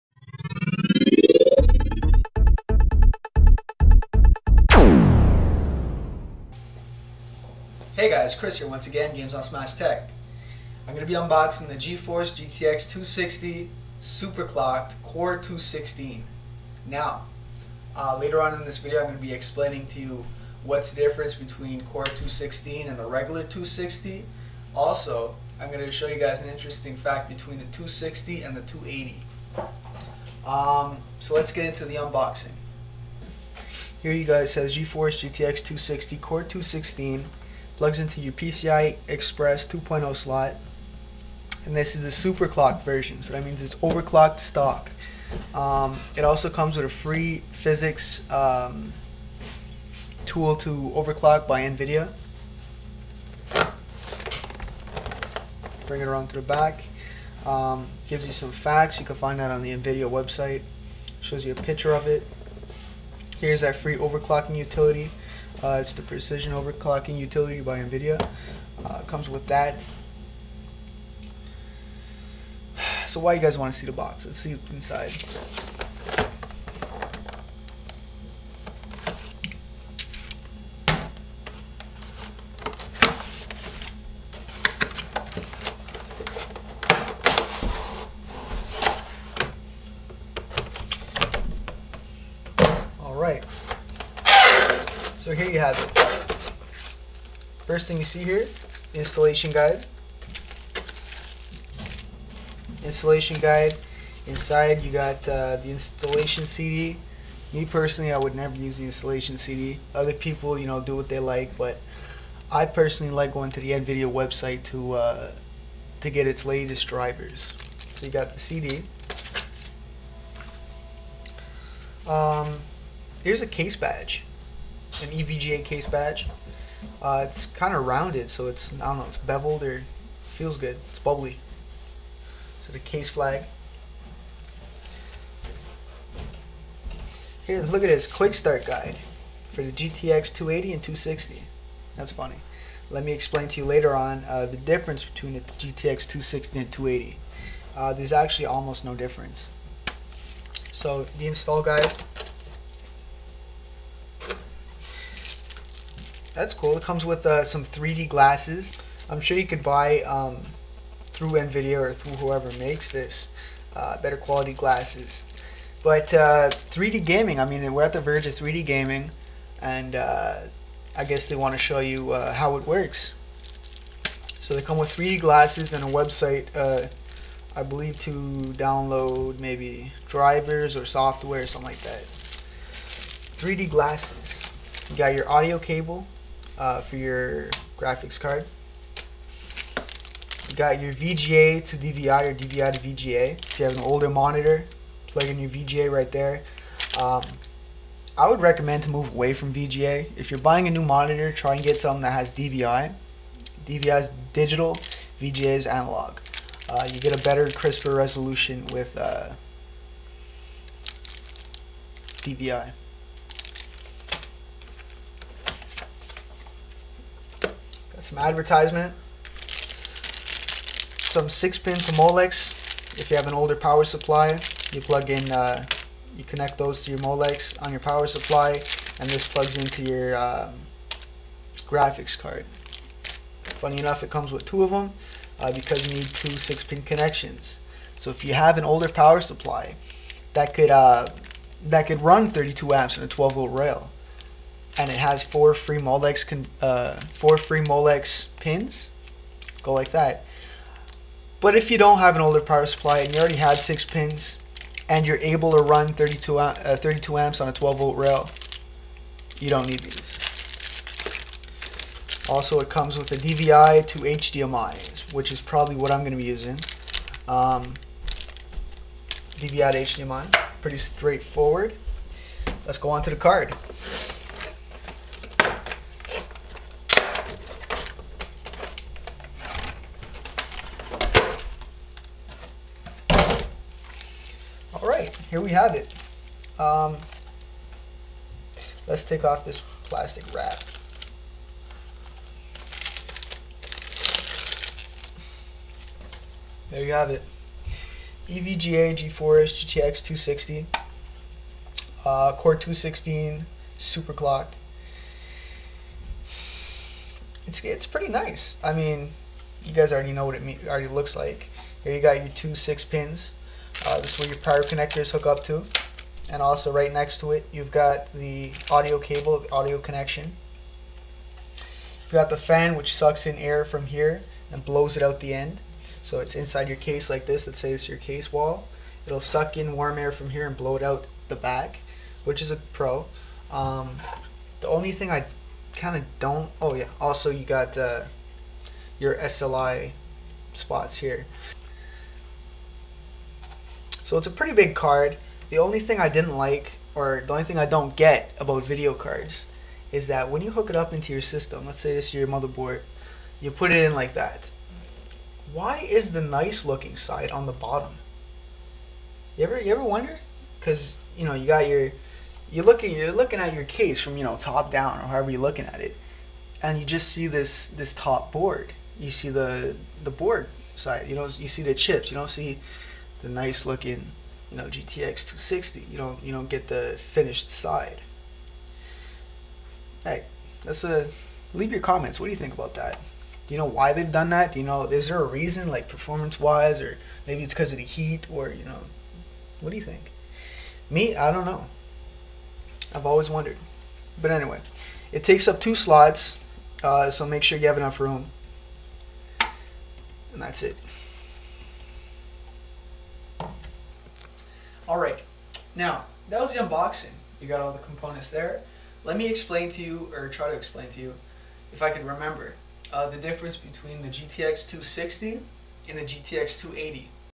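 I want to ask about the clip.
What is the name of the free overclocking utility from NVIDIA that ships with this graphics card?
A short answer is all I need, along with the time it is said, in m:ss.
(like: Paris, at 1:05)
Precision, at 1:06.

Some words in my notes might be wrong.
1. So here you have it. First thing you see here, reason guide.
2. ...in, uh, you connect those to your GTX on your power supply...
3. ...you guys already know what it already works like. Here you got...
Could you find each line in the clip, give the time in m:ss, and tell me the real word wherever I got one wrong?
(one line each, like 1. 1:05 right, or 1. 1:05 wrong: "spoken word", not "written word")
1. 1:35 wrong: "installation", not "reason"
2. 3:45 wrong: "Molex", not "GTX"
3. 5:09 wrong: "looks", not "works".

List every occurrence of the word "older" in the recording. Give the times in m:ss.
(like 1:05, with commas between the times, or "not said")
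3:13, 3:43, 3:58, 4:12.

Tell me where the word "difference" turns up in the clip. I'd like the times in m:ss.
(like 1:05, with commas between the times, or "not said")
0:20, 2:24, 2:28, 6:53.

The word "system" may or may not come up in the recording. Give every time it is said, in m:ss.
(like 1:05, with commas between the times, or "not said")
5:51.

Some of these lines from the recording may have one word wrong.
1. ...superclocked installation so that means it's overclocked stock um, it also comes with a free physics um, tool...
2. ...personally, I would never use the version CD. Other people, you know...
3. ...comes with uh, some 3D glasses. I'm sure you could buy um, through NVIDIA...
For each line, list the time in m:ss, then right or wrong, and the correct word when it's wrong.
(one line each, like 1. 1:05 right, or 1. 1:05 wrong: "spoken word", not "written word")
1. 0:42 wrong: "version", not "installation"
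2. 1:47 wrong: "installation", not "version"
3. 2:36 right.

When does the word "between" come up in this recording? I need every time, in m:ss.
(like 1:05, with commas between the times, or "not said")
0:21, 0:27, 2:25, 6:53.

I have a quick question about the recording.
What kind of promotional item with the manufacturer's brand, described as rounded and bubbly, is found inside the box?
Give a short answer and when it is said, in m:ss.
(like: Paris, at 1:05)
EVGA case badge, at 2:05.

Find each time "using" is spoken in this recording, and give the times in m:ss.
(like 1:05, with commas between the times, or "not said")
4:26.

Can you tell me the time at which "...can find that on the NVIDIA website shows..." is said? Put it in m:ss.
0:59.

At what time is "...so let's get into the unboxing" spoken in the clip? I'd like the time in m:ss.
0:31.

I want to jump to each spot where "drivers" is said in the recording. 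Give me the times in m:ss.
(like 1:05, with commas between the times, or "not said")
1:56, 3:00.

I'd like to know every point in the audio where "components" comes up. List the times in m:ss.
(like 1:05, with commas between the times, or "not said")
6:47.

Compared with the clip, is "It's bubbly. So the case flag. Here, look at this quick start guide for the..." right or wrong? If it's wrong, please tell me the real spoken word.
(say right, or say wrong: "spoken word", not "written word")
right.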